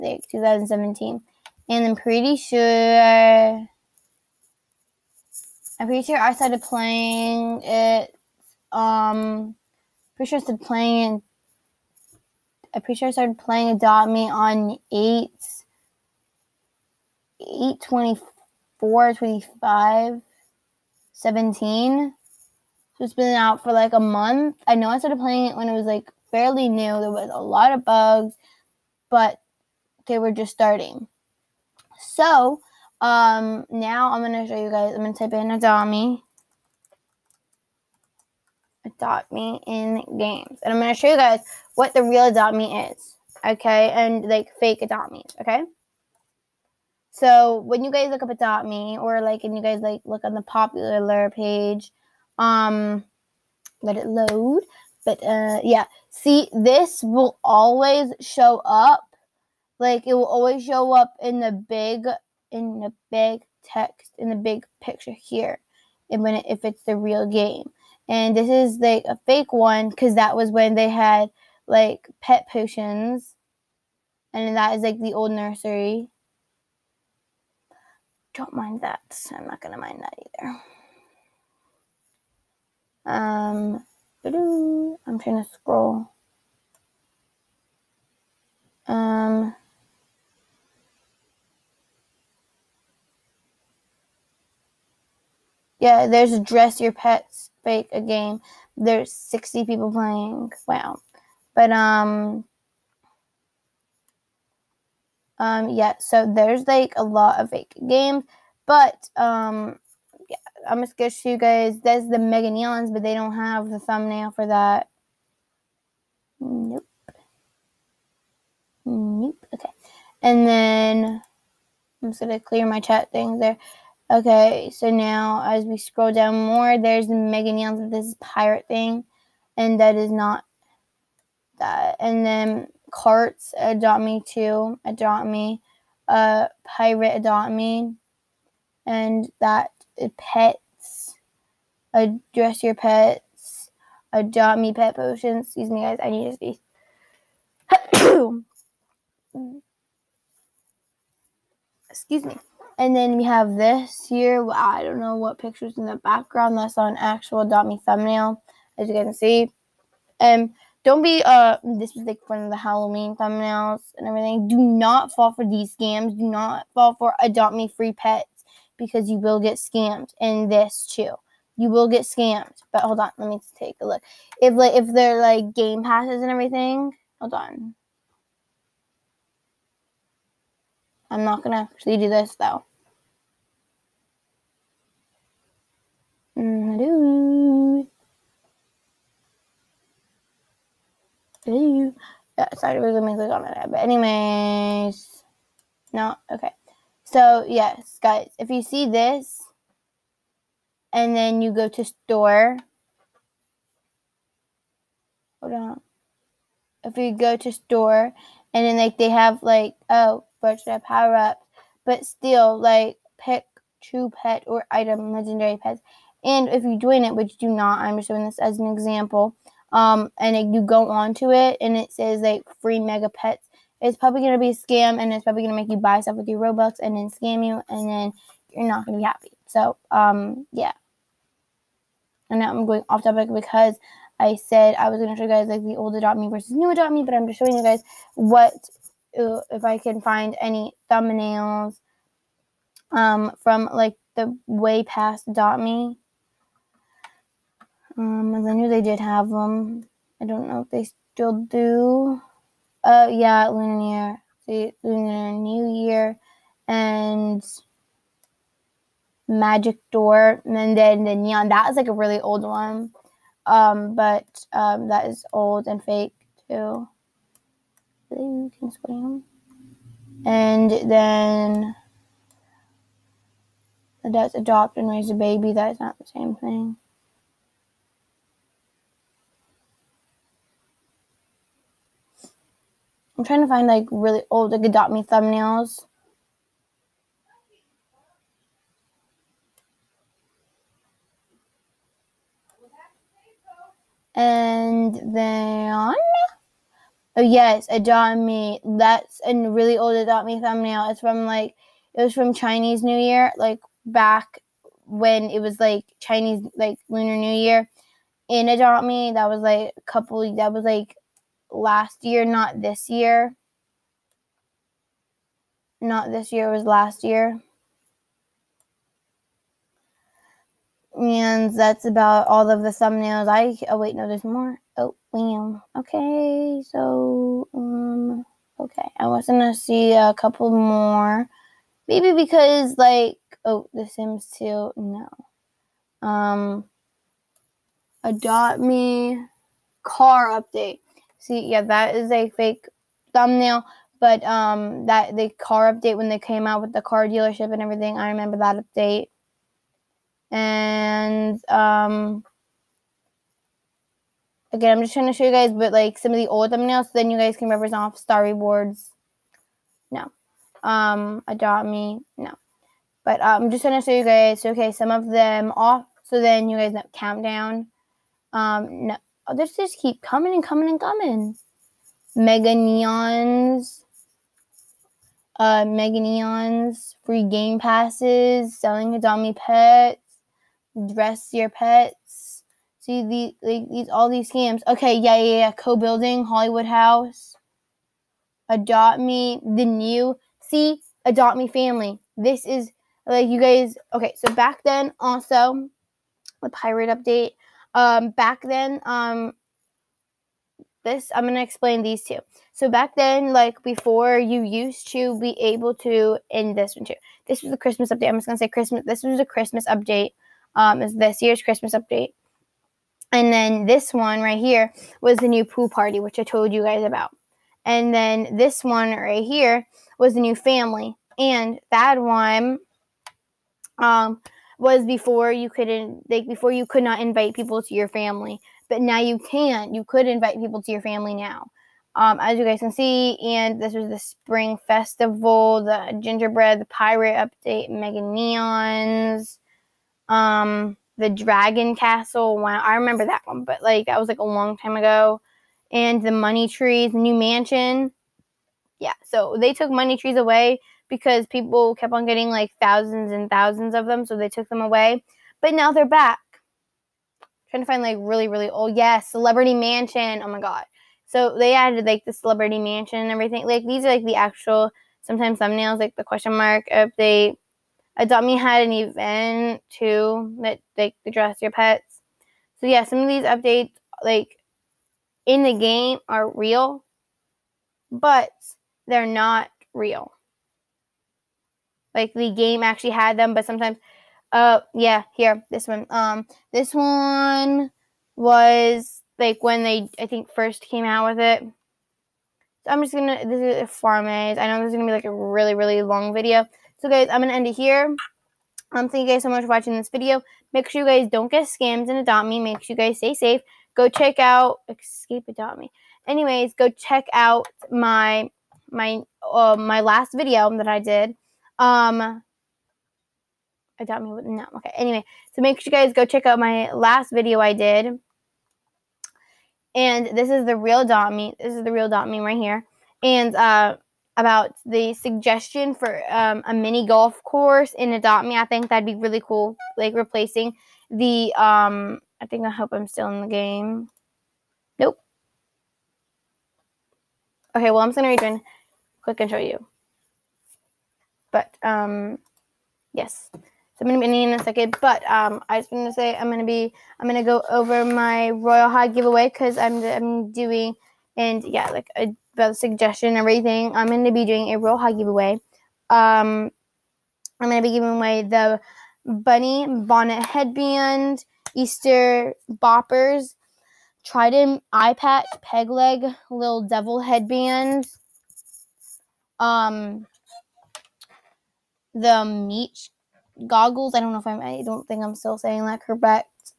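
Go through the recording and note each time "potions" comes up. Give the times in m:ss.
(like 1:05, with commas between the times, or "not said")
1:12, 2:24.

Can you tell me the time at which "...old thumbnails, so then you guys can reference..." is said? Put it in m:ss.
5:56.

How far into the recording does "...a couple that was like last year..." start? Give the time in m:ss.
5:09.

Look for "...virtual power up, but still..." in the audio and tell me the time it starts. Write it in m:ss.
3:30.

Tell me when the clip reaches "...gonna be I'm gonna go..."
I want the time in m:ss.
9:06.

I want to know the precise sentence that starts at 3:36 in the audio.
And if you join it, which you do not, I'm just showing this as an example.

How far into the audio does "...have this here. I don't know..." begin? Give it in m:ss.
2:33.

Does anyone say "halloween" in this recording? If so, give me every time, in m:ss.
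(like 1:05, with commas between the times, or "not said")
2:42.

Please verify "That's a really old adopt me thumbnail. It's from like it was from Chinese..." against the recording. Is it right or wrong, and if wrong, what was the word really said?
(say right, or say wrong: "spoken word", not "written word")
right.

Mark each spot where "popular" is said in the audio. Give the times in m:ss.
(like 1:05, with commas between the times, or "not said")
0:50.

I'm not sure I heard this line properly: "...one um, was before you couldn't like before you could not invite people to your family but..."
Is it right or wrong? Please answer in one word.
right.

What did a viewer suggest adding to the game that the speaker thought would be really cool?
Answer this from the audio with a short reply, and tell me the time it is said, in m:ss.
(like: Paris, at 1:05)
Mini golf course, at 8:46.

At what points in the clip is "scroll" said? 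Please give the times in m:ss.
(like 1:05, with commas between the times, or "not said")
1:25, 2:05.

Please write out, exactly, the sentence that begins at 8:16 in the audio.
So guys, I'm gonna end it here.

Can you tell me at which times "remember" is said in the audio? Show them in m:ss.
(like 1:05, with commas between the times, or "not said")
5:48, 7:22.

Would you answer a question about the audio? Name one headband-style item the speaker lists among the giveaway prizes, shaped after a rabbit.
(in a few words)
Bunny bonnet headband.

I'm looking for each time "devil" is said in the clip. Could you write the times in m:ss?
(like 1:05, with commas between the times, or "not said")
9:26.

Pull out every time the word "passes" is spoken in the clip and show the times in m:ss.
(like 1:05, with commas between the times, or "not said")
2:55, 6:17.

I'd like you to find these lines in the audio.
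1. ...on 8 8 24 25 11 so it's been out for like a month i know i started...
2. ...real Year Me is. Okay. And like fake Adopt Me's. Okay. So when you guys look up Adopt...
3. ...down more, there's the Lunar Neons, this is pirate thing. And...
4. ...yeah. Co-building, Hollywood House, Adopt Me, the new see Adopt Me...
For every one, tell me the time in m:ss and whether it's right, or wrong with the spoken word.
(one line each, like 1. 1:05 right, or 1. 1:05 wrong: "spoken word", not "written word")
1. 0:14 wrong: "17", not "11"
2. 0:42 wrong: "Adopt", not "Year"
3. 2:06 wrong: "Mega", not "Lunar"
4. 6:25 right.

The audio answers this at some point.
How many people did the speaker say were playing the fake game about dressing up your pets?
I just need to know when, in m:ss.
1:39.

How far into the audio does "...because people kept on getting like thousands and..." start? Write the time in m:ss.
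7:30.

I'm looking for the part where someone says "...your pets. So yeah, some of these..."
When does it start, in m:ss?
7:51.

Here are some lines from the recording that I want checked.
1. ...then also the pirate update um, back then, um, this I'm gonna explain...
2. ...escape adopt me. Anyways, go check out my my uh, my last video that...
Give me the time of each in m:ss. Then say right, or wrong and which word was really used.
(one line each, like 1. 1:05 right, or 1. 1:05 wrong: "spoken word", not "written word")
1. 6:34 right
2. 8:24 right.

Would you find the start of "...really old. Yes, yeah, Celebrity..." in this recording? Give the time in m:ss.
7:38.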